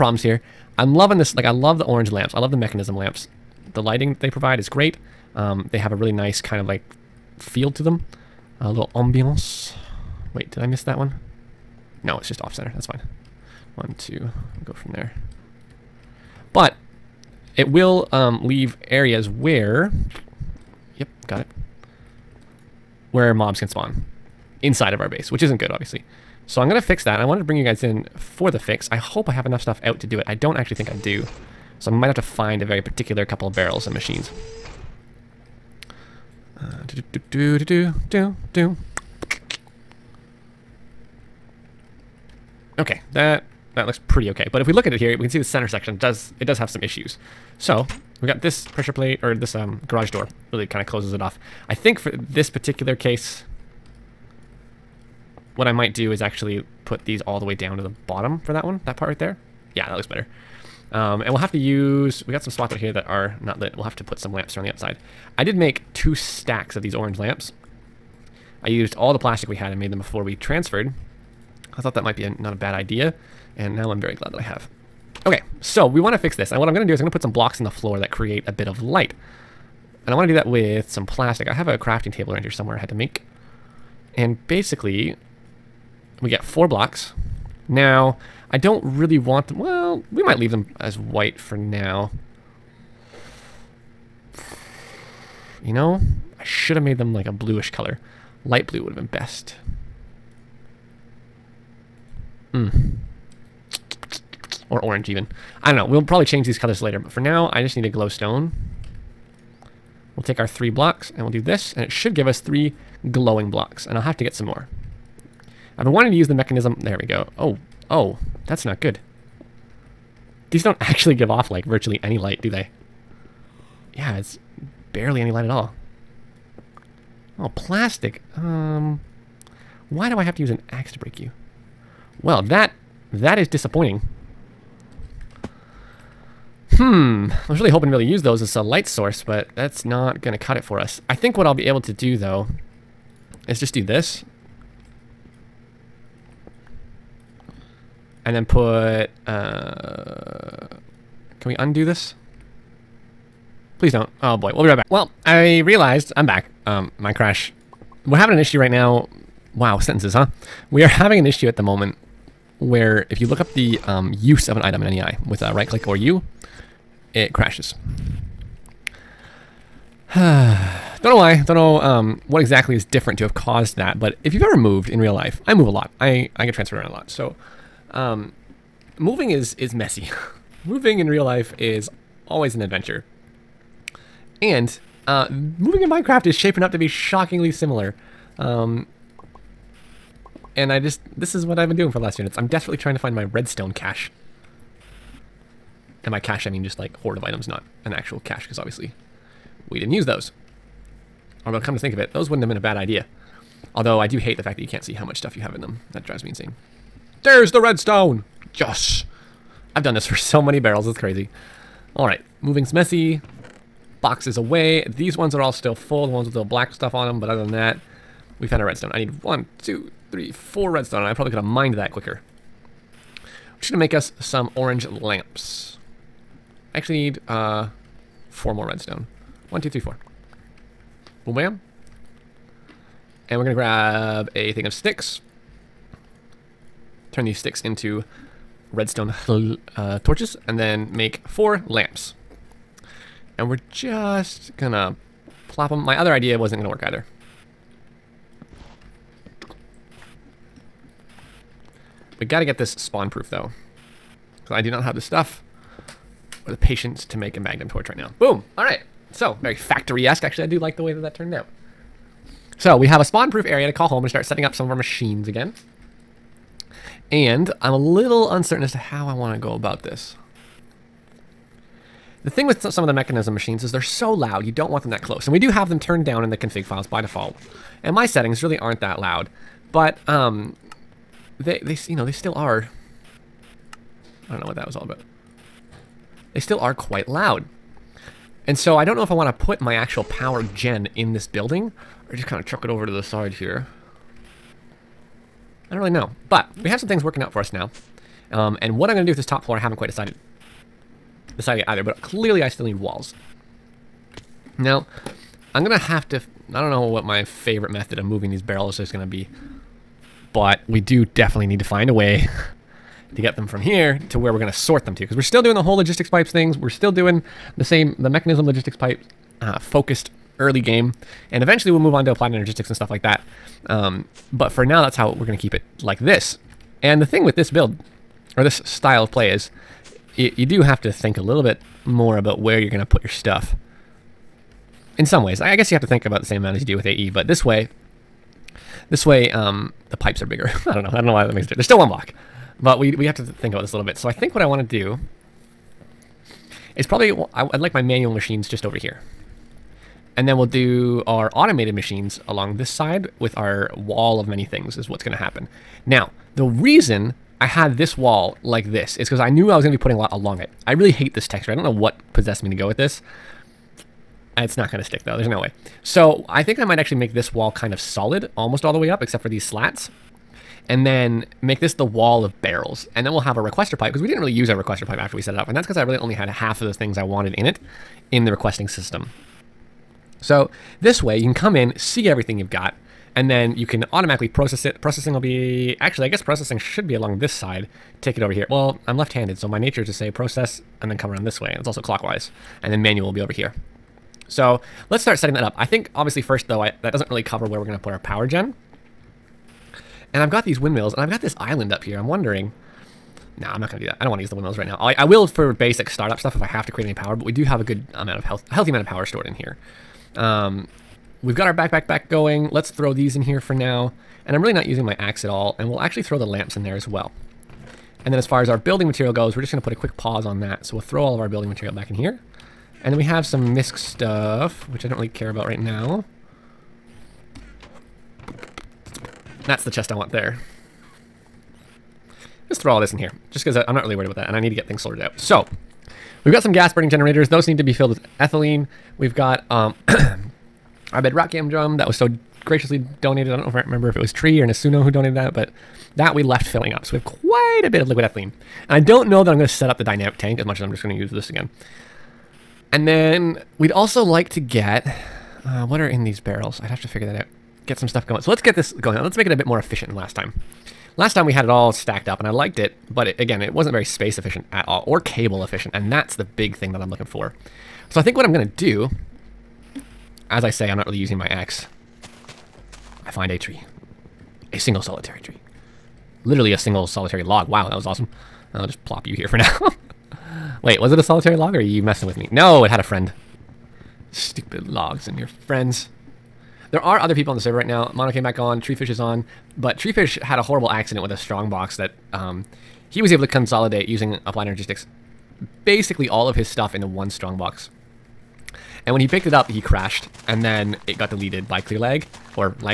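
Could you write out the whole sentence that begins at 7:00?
So we'll throw all of our building material back in here.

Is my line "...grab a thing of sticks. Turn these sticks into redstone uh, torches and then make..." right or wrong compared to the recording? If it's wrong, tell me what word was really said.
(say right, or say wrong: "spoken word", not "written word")
right.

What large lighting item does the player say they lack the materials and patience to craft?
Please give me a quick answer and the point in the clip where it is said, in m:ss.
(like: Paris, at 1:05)
magnum torch, at 4:17.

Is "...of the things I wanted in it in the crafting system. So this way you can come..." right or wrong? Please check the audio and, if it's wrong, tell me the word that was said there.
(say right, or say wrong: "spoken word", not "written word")
wrong: "requesting", not "crafting".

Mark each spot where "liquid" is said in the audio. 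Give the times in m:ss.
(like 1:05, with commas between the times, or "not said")
7:27.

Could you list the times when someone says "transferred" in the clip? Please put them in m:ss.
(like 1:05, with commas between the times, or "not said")
1:10, 2:56.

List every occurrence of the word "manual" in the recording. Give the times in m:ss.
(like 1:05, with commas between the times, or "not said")
5:47, 6:32.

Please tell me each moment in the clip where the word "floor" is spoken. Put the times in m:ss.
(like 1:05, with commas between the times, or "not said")
1:17, 4:59.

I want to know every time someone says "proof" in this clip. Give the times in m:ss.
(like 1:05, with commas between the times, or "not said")
4:13, 4:23.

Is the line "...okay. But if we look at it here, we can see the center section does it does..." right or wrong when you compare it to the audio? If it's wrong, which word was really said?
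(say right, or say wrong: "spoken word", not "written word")
right.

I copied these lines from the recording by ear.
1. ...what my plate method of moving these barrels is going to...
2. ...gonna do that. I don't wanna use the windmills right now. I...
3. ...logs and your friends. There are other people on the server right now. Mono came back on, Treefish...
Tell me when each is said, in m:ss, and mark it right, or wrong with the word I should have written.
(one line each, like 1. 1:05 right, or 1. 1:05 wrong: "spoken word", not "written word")
1. 5:06 wrong: "favorite", not "plate"
2. 6:43 right
3. 8:04 right.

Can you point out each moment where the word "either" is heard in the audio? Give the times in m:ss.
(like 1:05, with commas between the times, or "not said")
4:06, 5:01.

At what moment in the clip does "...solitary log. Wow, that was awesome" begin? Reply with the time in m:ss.
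7:56.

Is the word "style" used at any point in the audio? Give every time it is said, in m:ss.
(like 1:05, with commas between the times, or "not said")
5:28.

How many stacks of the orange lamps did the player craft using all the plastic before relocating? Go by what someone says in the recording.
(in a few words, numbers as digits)
2.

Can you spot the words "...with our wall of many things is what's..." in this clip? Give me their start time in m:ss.
5:53.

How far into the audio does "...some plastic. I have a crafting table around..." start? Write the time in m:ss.
1:20.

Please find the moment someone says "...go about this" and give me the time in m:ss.
4:29.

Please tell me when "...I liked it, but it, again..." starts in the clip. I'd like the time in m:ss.
7:42.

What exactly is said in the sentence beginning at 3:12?
I'm desperately trying to find my redstone cache.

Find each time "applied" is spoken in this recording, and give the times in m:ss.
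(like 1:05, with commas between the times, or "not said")
5:22, 8:14.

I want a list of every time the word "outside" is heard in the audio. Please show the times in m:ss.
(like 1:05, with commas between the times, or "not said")
1:04.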